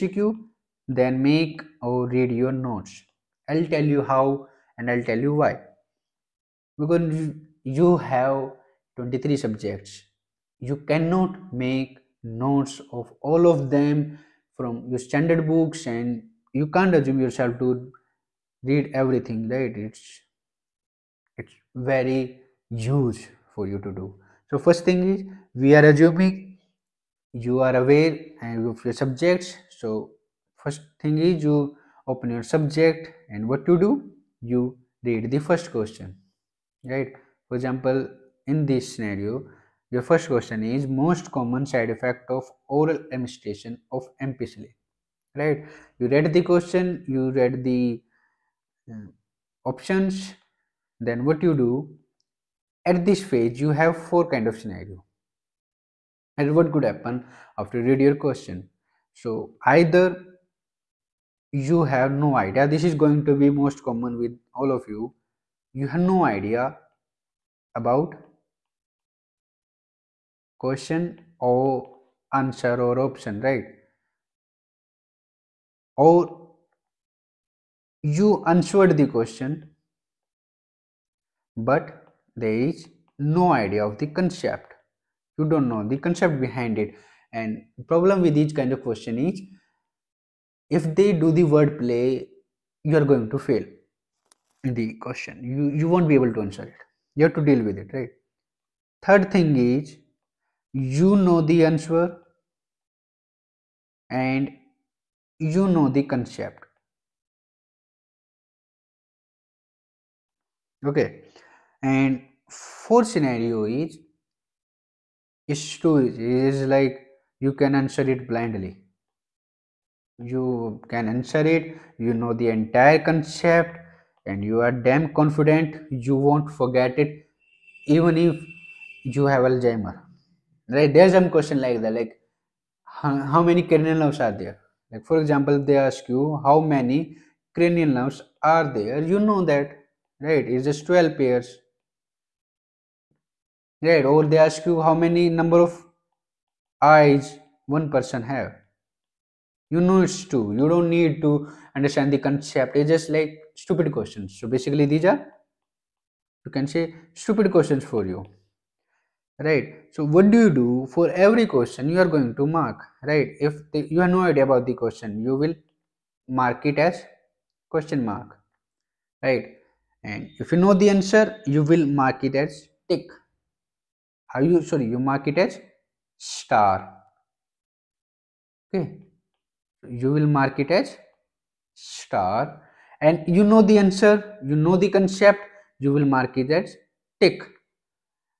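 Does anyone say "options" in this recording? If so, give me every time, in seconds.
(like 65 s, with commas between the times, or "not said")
49 s, 73 s.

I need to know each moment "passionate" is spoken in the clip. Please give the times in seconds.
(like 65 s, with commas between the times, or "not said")
not said.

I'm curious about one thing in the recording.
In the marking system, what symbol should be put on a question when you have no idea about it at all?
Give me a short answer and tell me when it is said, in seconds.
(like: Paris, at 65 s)
Question mark, at 167 s.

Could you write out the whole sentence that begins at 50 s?
Then what you do at this phase, you have four kind of scenario.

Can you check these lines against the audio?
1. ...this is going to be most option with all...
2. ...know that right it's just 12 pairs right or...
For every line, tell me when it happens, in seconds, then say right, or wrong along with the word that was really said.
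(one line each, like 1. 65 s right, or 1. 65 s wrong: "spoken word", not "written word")
1. 62 s wrong: "common", not "option"
2. 139 s right.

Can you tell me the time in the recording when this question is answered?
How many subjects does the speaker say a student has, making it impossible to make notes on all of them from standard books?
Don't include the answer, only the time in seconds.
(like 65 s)
9 s.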